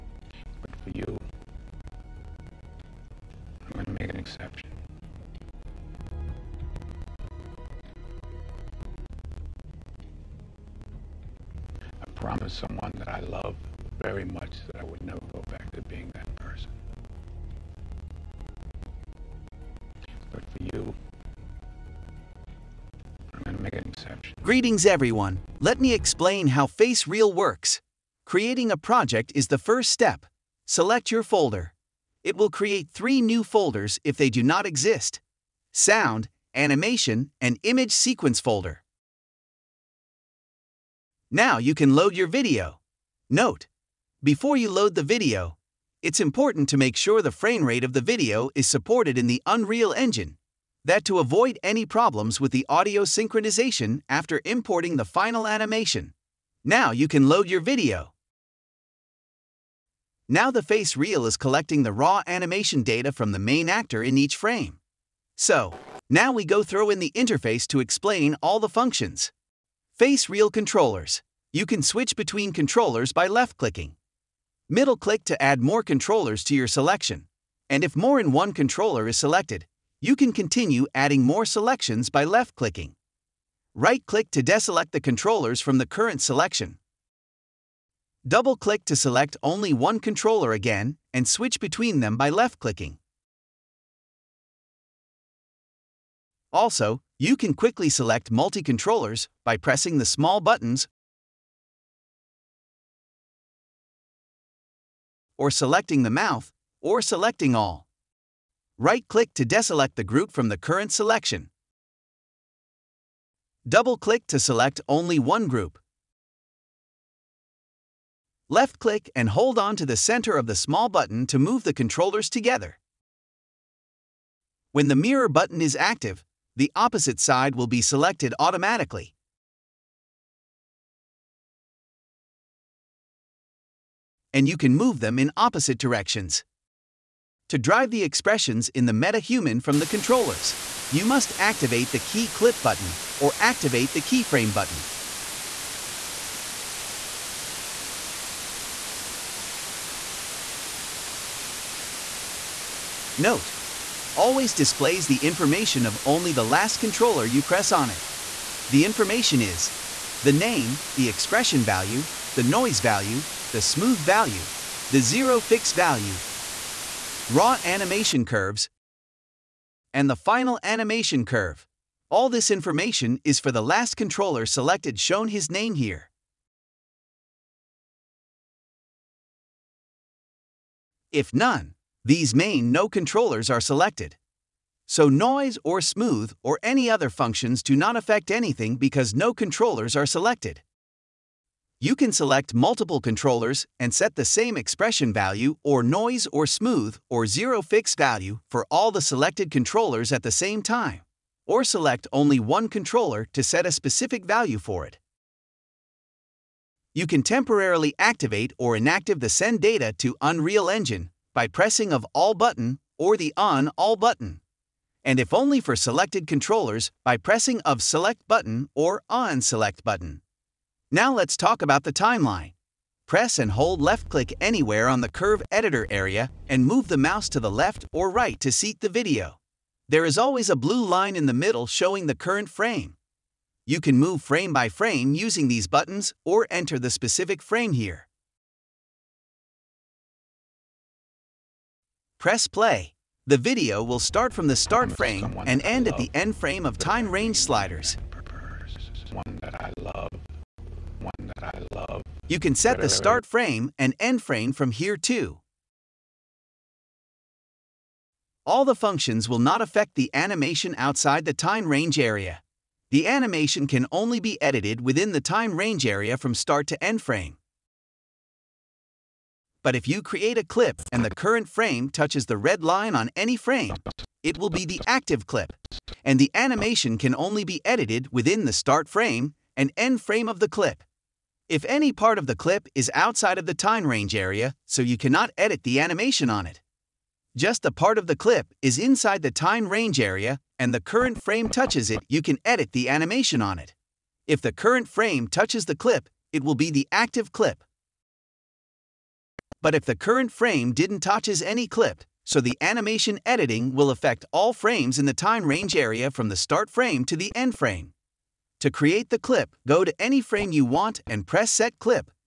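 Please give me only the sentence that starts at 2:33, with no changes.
Note, always displays the information of only the last controller you press on it.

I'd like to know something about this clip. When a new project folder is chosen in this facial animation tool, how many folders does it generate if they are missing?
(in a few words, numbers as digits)
3.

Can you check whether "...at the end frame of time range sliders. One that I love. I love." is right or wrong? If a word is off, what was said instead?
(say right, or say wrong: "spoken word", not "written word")
right.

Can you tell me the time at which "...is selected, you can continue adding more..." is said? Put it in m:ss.
1:19.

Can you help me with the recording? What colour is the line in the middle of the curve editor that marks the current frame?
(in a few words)
Blue.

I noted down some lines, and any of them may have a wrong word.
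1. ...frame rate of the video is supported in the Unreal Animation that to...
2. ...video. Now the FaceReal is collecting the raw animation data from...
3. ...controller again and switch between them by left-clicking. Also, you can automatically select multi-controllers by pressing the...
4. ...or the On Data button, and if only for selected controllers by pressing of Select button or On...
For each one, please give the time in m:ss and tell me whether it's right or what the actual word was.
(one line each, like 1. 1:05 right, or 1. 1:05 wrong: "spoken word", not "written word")
1. 0:47 wrong: "Engine", not "Animation"
2. 0:57 right
3. 1:29 wrong: "quickly", not "automatically"
4. 3:32 wrong: "All", not "Data".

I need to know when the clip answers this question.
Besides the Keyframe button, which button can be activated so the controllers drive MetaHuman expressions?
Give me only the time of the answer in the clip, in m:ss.
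2:21.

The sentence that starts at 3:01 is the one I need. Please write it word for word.
If none, these main no controllers are selected.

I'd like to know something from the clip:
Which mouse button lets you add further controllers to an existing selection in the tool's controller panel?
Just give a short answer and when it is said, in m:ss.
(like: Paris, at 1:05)
Middle click, at 1:14.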